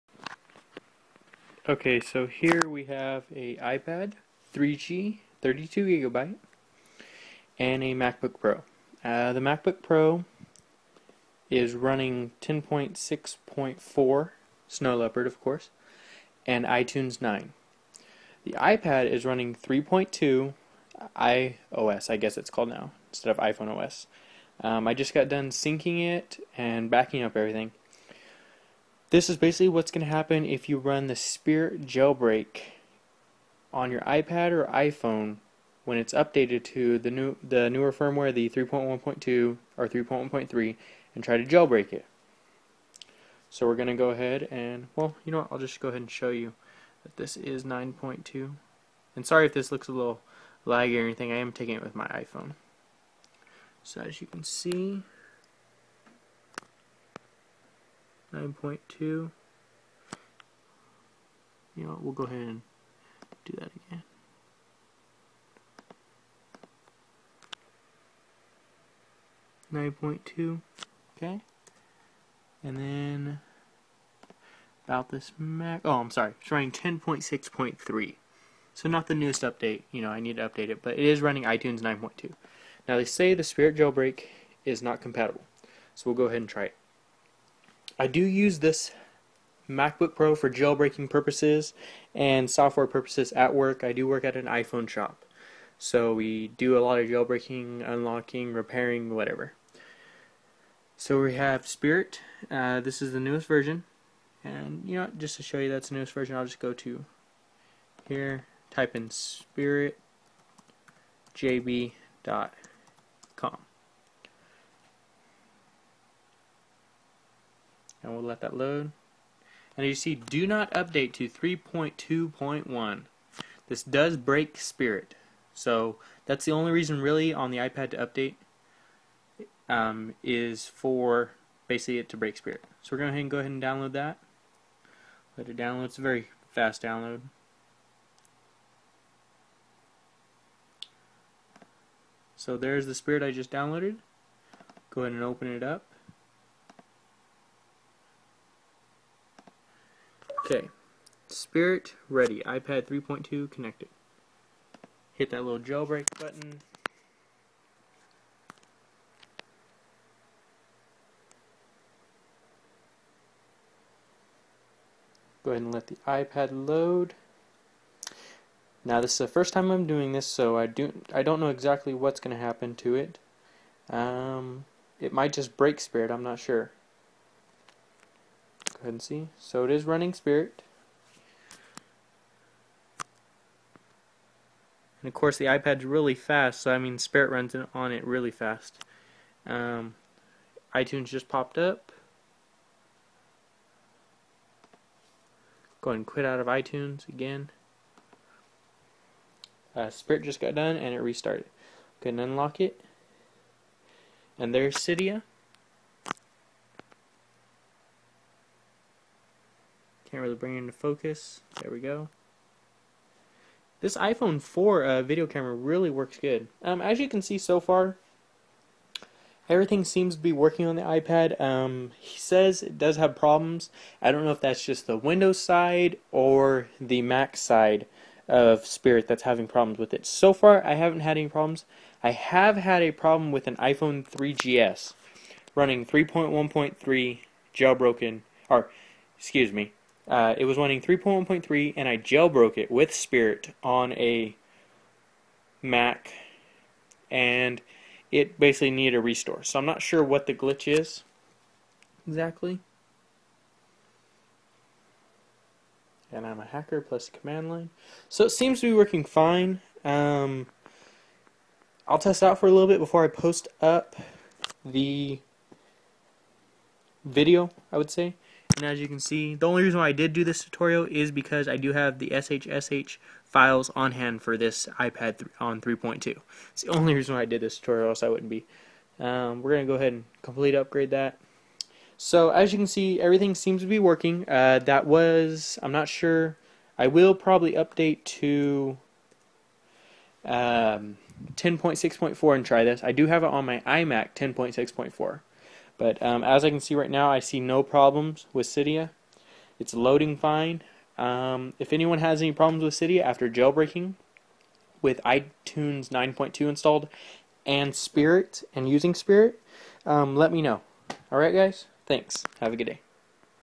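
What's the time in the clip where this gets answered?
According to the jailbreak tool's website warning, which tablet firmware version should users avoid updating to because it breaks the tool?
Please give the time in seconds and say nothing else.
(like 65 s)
121 s.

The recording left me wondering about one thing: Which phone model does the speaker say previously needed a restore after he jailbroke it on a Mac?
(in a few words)
iPhone 3GS.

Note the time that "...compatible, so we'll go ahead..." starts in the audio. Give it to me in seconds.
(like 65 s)
84 s.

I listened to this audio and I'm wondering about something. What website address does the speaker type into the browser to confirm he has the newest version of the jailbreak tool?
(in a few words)
spiritjb.com.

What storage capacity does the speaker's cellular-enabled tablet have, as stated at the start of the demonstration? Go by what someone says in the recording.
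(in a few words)
32 gigabytes.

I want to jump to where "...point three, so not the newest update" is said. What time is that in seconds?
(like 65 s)
77 s.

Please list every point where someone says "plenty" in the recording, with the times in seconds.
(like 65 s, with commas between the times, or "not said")
not said.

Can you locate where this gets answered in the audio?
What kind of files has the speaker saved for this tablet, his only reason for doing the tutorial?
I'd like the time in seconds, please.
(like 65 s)
272 s.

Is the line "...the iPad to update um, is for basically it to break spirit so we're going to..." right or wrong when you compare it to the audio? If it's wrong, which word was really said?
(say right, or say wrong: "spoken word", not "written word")
right.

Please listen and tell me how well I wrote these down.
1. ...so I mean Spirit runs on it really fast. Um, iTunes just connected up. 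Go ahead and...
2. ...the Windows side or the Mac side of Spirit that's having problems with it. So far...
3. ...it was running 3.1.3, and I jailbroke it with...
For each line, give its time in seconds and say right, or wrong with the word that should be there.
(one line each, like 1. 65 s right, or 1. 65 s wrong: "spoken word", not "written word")
1. 186 s wrong: "popped", not "connected"
2. 224 s right
3. 240 s right.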